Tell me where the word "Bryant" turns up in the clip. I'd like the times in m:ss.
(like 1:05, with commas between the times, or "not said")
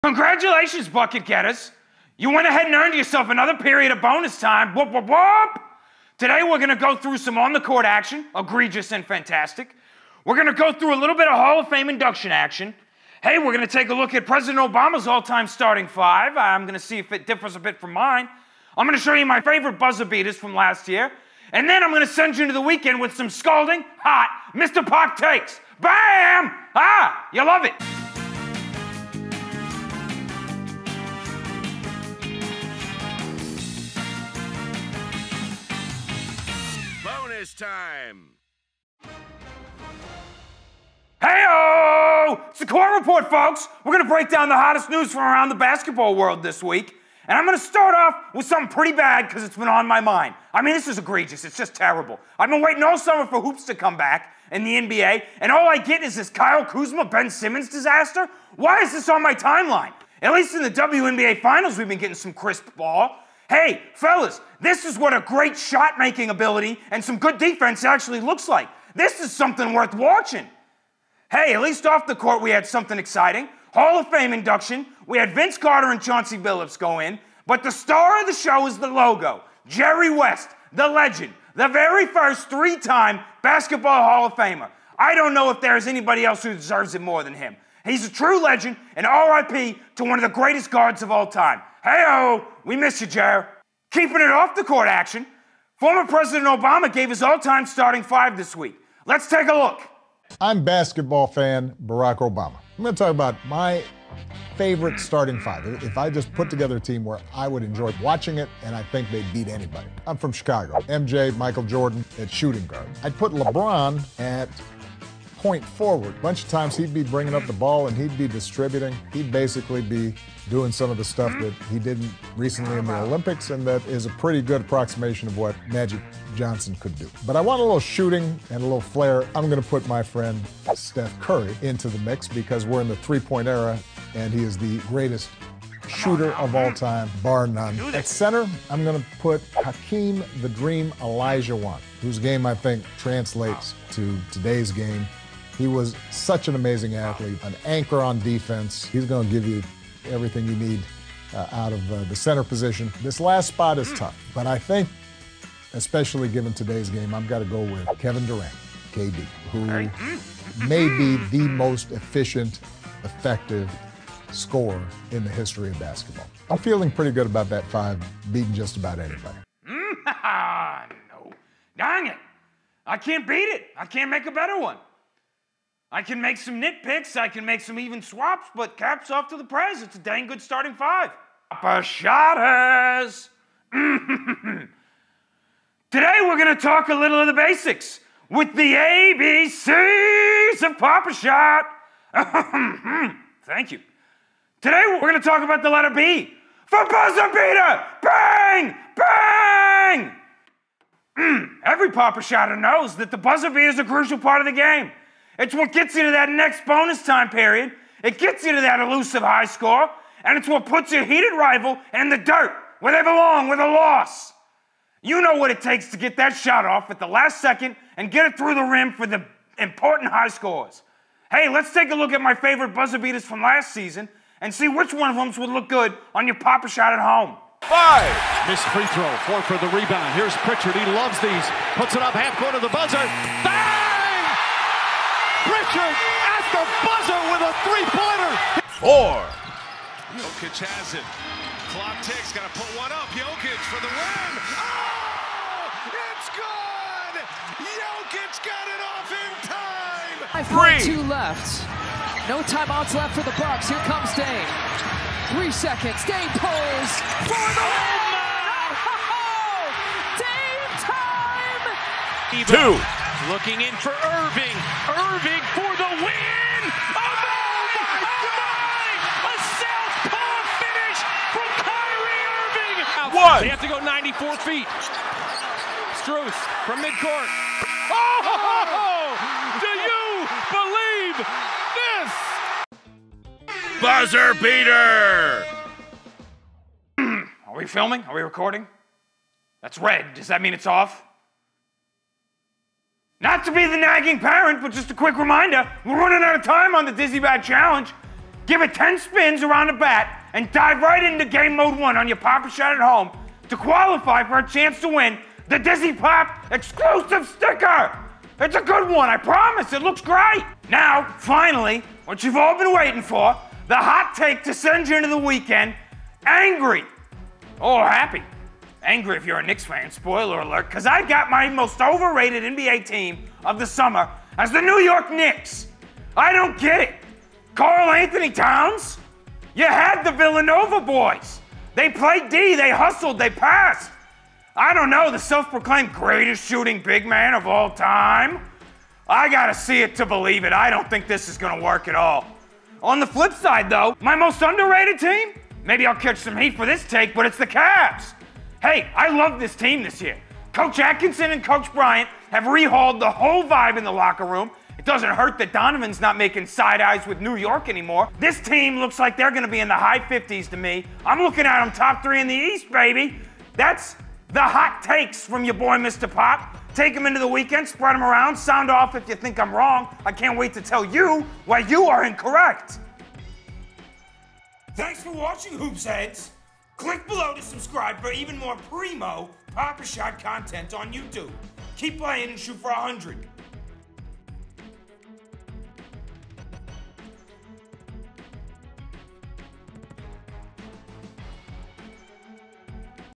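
5:51.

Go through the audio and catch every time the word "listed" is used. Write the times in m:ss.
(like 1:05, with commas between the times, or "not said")
not said.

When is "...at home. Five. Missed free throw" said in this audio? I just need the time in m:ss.
3:46.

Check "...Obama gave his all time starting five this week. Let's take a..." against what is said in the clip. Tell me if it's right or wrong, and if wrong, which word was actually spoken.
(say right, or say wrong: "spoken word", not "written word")
right.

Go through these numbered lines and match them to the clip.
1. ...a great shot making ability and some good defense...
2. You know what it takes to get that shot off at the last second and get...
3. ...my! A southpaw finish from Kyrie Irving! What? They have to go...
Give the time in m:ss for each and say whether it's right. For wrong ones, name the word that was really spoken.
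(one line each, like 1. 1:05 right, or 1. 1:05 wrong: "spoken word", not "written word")
1. 1:05 right
2. 3:35 right
3. 4:28 right.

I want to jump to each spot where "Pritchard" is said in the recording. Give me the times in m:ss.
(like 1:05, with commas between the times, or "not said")
3:50, 3:55.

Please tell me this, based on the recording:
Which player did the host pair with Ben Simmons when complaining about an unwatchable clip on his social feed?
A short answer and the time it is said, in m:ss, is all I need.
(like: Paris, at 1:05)
Kyle Kuzma, at 0:56.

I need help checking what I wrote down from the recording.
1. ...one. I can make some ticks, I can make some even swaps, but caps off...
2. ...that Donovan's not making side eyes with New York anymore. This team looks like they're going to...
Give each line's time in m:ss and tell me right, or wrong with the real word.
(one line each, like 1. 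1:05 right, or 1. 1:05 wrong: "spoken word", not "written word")
1. 2:54 wrong: "nitpicks", not "ticks"
2. 5:55 right.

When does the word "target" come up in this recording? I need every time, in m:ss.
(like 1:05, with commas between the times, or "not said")
not said.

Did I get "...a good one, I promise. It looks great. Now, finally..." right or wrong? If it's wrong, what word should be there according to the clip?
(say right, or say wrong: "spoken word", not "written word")
right.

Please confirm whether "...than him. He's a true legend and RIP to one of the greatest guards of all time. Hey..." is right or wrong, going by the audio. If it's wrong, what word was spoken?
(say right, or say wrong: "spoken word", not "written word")
right.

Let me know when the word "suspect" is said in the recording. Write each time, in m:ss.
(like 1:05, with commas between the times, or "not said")
not said.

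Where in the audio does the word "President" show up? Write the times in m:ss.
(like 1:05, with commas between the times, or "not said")
0:14, 1:36.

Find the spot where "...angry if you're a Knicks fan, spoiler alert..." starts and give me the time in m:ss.
5:18.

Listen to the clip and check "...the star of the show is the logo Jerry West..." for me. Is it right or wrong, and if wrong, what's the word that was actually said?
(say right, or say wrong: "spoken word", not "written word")
right.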